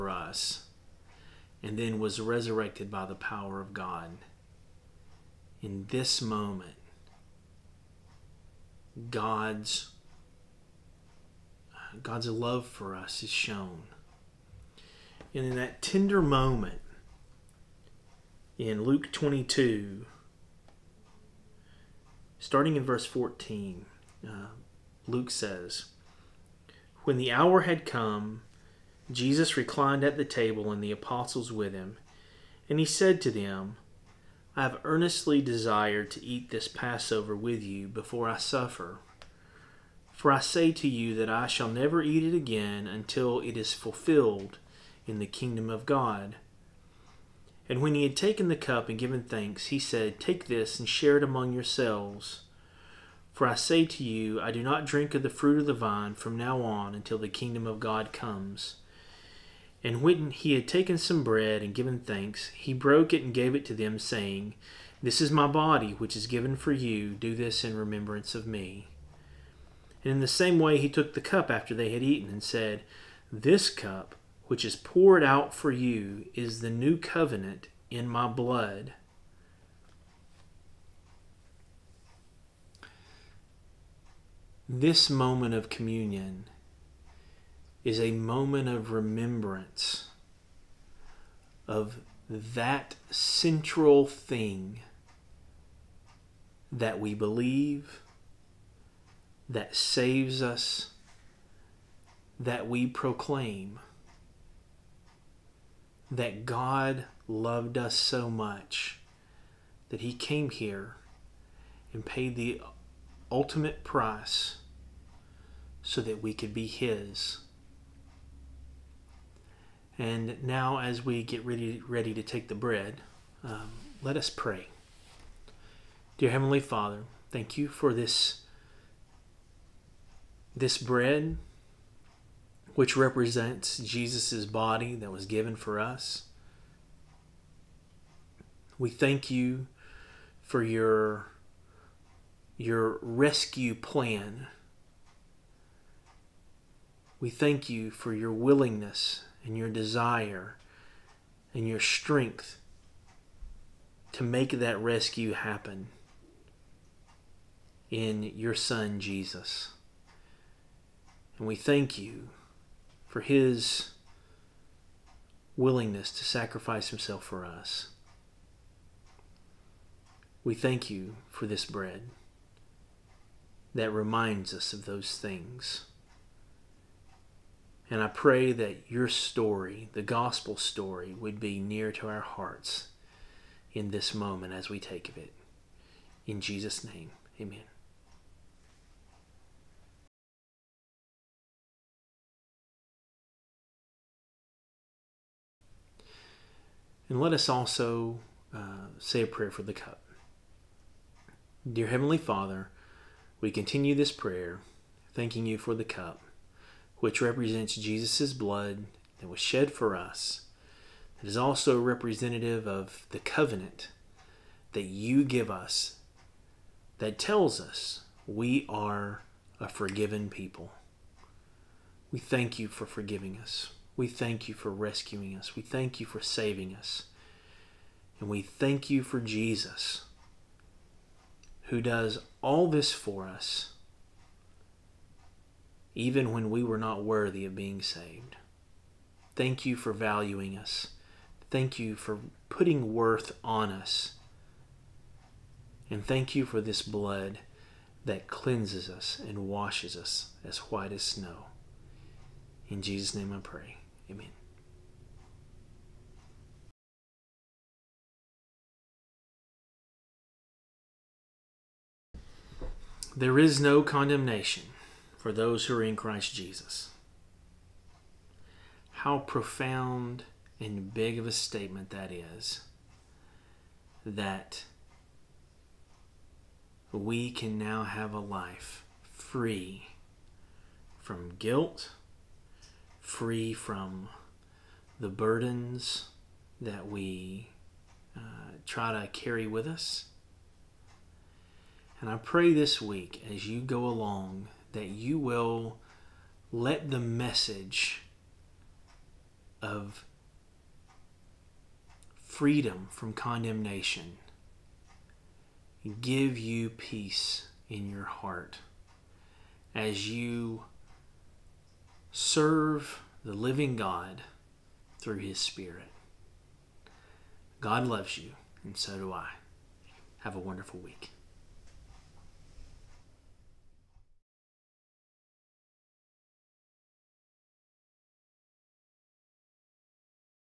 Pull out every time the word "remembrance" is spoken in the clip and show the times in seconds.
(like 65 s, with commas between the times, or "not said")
67 s, 88 s.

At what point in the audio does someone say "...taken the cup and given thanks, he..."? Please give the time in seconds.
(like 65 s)
48 s.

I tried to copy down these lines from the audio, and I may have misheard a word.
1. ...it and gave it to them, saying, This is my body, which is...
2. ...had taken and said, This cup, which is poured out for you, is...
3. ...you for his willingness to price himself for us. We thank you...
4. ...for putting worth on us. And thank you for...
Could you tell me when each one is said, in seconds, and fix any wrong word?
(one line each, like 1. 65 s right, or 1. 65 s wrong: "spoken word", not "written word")
1. 63 s right
2. 71 s wrong: "eaten", not "taken"
3. 161 s wrong: "sacrifice", not "price"
4. 241 s right.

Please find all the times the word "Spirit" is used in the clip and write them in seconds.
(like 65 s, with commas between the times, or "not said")
315 s.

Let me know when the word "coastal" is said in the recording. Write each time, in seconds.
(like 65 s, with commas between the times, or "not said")
not said.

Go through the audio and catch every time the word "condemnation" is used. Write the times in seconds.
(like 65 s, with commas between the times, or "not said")
263 s, 303 s.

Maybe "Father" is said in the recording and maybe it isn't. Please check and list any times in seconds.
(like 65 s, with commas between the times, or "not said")
126 s, 202 s.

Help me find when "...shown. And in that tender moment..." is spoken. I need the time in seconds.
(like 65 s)
13 s.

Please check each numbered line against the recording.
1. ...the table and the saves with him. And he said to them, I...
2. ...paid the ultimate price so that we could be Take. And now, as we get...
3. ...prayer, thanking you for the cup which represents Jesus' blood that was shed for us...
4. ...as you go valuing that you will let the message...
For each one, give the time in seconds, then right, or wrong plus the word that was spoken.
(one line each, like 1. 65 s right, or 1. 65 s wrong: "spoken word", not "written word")
1. 30 s wrong: "apostles", not "saves"
2. 112 s wrong: "His", not "Take"
3. 204 s right
4. 293 s wrong: "along", not "valuing".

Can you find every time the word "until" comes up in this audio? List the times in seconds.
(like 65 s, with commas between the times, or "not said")
42 s, 56 s.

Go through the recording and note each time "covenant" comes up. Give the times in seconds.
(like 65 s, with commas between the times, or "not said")
76 s, 213 s.